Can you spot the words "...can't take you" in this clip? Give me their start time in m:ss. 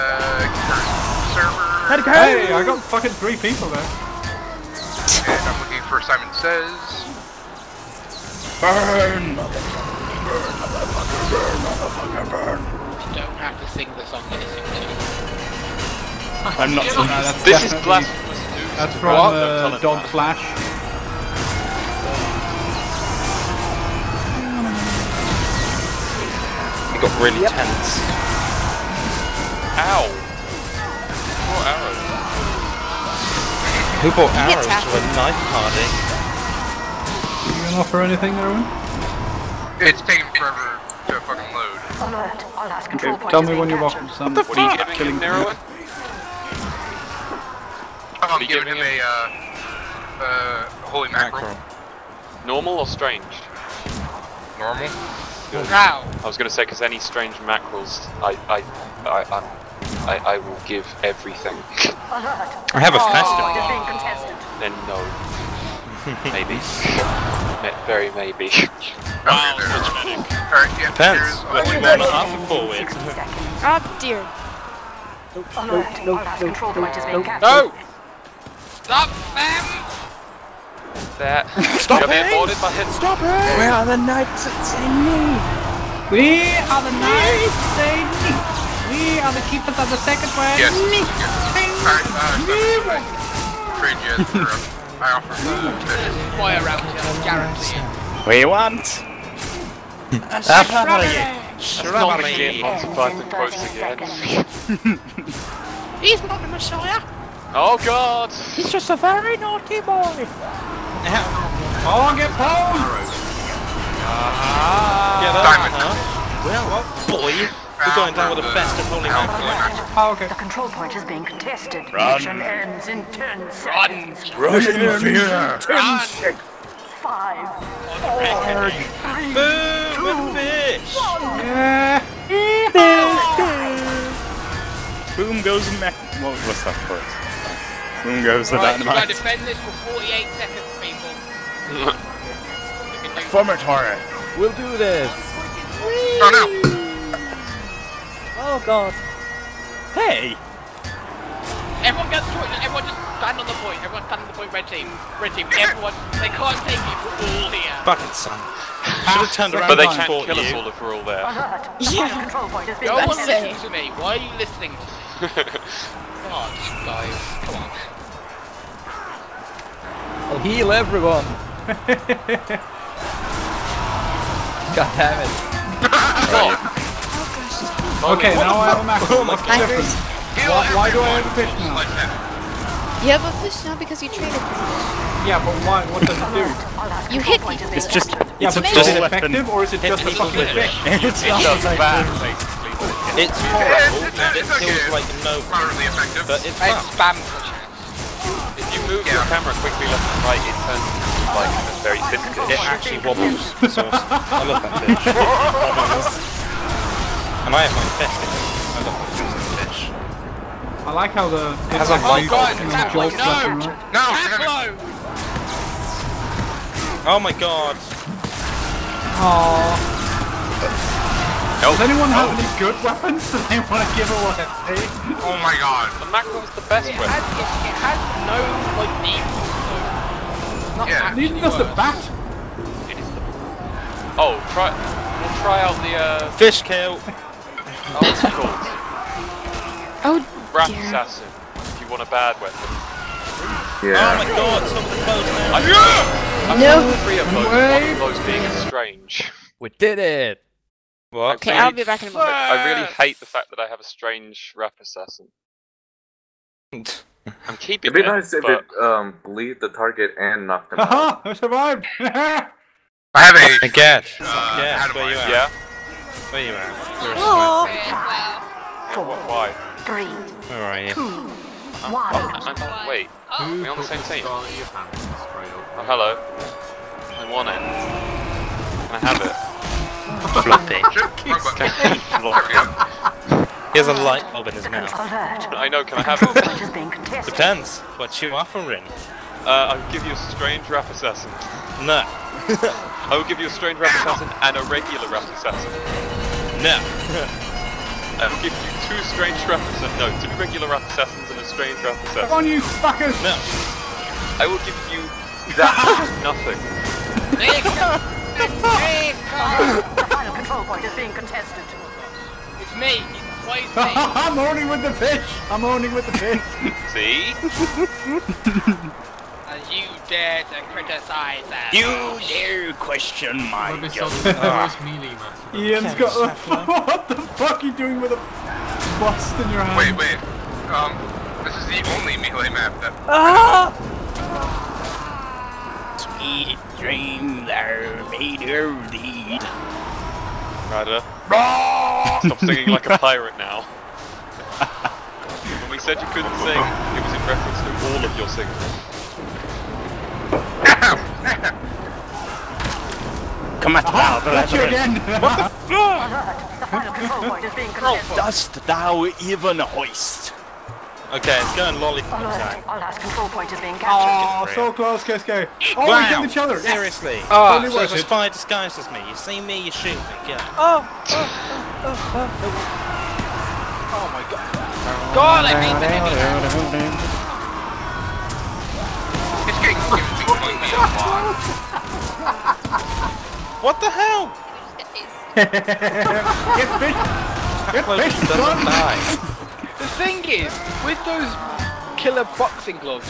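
2:36.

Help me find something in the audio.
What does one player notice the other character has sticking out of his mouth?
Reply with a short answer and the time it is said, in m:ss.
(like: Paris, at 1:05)
A light bulb, at 4:43.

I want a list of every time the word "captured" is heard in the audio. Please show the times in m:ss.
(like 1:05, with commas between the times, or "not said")
6:03.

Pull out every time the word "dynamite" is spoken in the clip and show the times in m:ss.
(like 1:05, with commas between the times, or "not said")
2:18.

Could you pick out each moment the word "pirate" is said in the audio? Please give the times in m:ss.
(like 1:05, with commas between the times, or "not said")
5:42.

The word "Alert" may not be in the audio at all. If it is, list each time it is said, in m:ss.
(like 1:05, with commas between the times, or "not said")
0:42, 6:02.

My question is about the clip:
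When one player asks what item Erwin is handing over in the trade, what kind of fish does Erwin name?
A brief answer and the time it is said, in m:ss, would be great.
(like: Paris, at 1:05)
Holy mackerel, at 0:50.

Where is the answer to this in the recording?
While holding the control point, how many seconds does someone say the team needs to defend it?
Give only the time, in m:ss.
2:19.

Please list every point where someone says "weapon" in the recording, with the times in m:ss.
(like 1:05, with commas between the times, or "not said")
3:42, 3:46, 4:02.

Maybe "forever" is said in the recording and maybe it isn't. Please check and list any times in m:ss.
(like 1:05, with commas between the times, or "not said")
0:40.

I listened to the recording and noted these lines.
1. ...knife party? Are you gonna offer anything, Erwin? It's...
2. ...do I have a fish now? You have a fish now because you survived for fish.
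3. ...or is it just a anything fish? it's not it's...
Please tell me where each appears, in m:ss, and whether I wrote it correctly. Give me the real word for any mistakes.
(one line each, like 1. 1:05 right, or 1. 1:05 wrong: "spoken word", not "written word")
1. 0:35 right
2. 3:00 wrong: "traded", not "survived"
3. 3:09 wrong: "fucking", not "anything".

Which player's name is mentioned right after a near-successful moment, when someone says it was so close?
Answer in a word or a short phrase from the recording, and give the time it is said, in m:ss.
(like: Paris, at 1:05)
Kesko, at 6:05.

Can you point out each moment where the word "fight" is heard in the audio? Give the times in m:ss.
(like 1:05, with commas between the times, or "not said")
not said.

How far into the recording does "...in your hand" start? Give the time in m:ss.
5:29.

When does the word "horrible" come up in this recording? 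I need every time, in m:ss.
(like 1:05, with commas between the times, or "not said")
3:13.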